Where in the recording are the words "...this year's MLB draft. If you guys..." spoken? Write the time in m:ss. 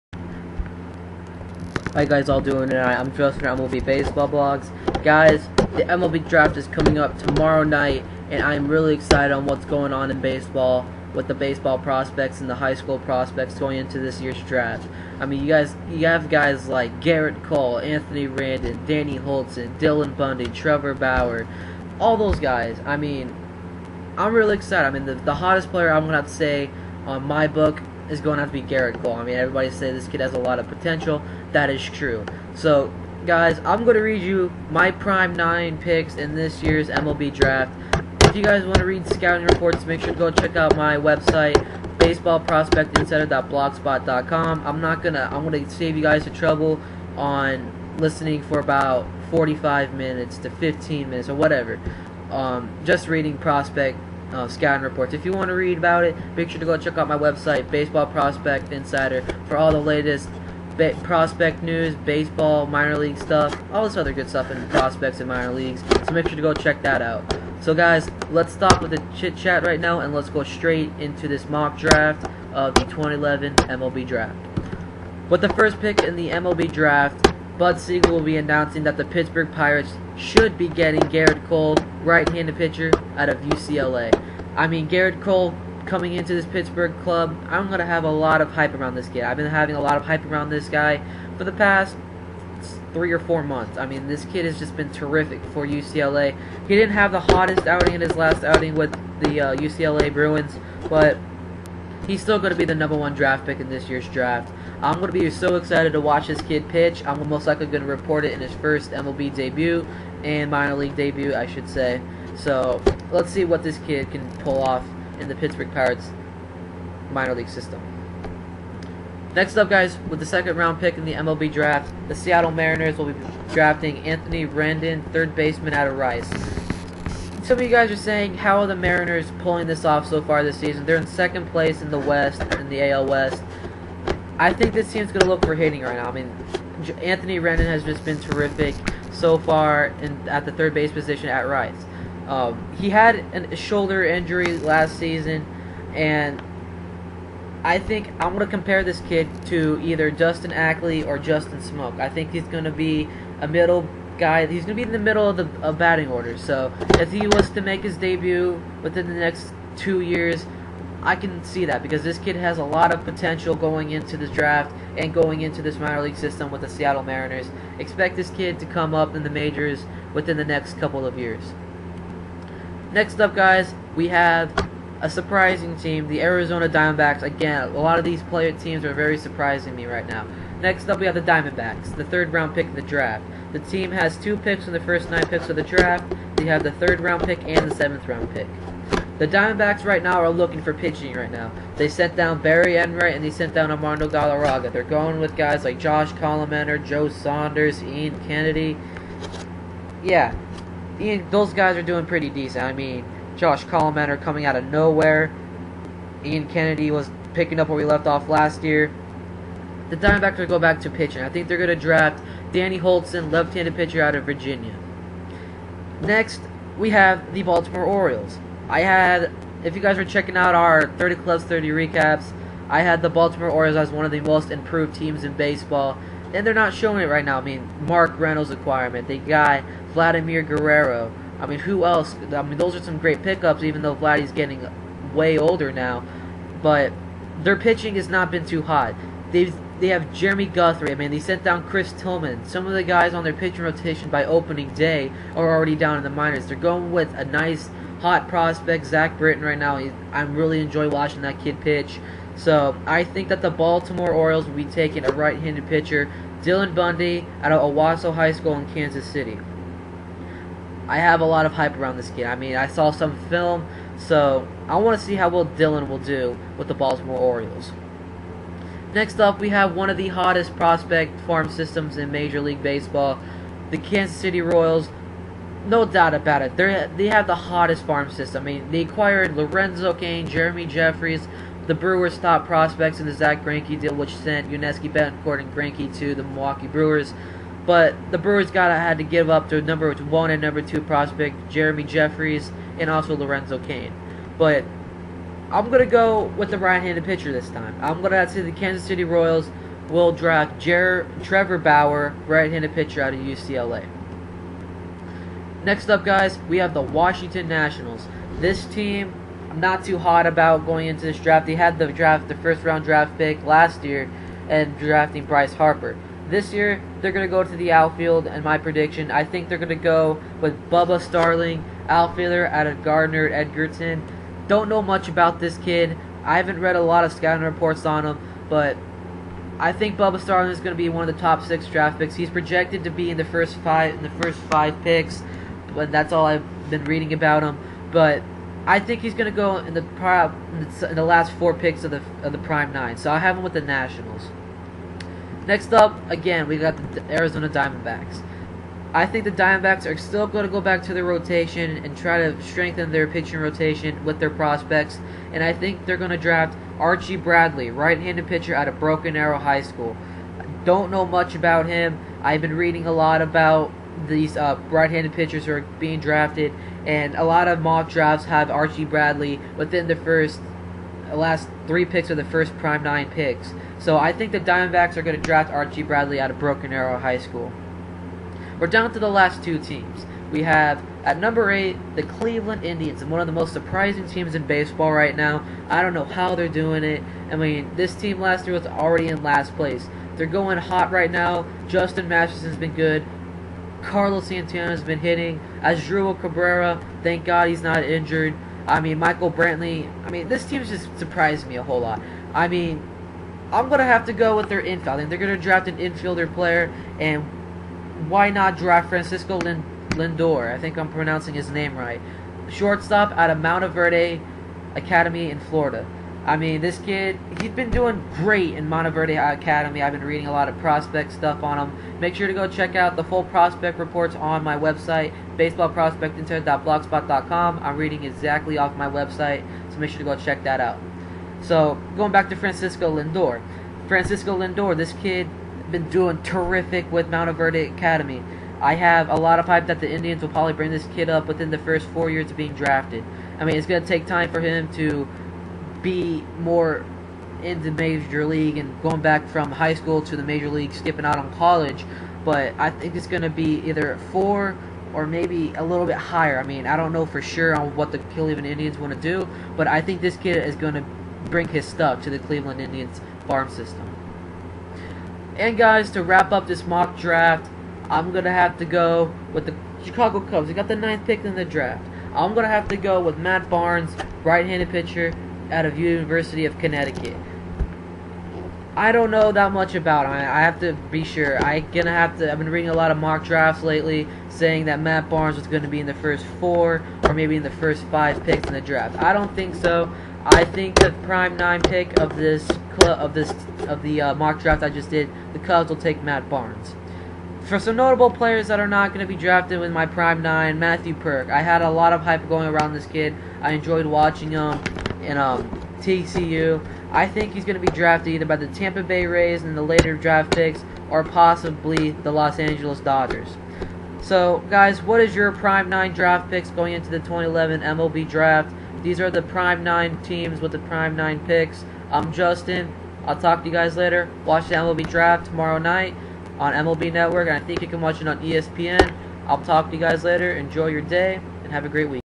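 0:36.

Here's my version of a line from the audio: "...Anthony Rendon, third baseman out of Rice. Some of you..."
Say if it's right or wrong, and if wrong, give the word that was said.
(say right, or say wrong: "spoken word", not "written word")
right.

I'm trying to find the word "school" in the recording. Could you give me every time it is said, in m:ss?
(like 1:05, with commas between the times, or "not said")
0:12, 4:18, 5:59, 6:17, 7:29.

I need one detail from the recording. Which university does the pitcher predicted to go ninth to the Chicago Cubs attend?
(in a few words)
University of Connecticut.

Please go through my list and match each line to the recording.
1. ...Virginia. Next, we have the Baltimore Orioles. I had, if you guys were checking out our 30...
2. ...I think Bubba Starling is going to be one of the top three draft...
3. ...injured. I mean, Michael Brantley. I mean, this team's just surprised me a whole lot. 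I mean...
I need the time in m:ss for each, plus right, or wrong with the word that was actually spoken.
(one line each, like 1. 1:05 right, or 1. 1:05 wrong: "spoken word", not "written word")
1. 3:34 right
2. 5:29 wrong: "six", not "three"
3. 6:37 right.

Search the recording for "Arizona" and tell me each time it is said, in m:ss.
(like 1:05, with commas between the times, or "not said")
2:56, 5:47.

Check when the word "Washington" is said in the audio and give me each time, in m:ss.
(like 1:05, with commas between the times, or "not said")
5:06.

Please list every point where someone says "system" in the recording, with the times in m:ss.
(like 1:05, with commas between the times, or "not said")
1:57, 2:46, 4:31, 4:38, 7:43.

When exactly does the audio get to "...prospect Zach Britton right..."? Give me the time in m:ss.
4:08.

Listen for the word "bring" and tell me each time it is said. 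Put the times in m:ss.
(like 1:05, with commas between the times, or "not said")
7:20, 7:41.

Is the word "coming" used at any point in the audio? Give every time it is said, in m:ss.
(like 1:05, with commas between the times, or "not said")
0:06, 1:25, 3:24.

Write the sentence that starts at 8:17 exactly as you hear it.
For some notable players that are not going to be drafted with my prime nine, Matthew Purke.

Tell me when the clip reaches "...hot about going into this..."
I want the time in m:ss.
5:09.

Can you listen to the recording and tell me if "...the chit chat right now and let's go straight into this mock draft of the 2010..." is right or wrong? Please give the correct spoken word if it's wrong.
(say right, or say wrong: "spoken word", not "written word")
wrong: "2011", not "2010".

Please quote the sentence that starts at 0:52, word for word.
Um, just reading prospect uh, scouting reports.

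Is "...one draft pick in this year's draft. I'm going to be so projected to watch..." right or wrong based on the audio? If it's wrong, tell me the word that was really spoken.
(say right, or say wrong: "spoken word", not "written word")
wrong: "excited", not "projected".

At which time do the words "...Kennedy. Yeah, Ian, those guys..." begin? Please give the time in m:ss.
3:18.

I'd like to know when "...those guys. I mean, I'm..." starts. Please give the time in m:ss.
0:22.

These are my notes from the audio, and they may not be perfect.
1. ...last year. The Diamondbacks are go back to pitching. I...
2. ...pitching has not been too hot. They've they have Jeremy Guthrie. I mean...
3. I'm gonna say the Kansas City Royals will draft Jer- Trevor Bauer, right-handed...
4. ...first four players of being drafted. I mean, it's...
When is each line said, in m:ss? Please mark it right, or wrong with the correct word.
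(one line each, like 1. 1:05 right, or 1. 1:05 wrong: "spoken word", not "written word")
1. 3:28 right
2. 3:57 right
3. 4:57 right
4. 7:21 wrong: "years", not "players".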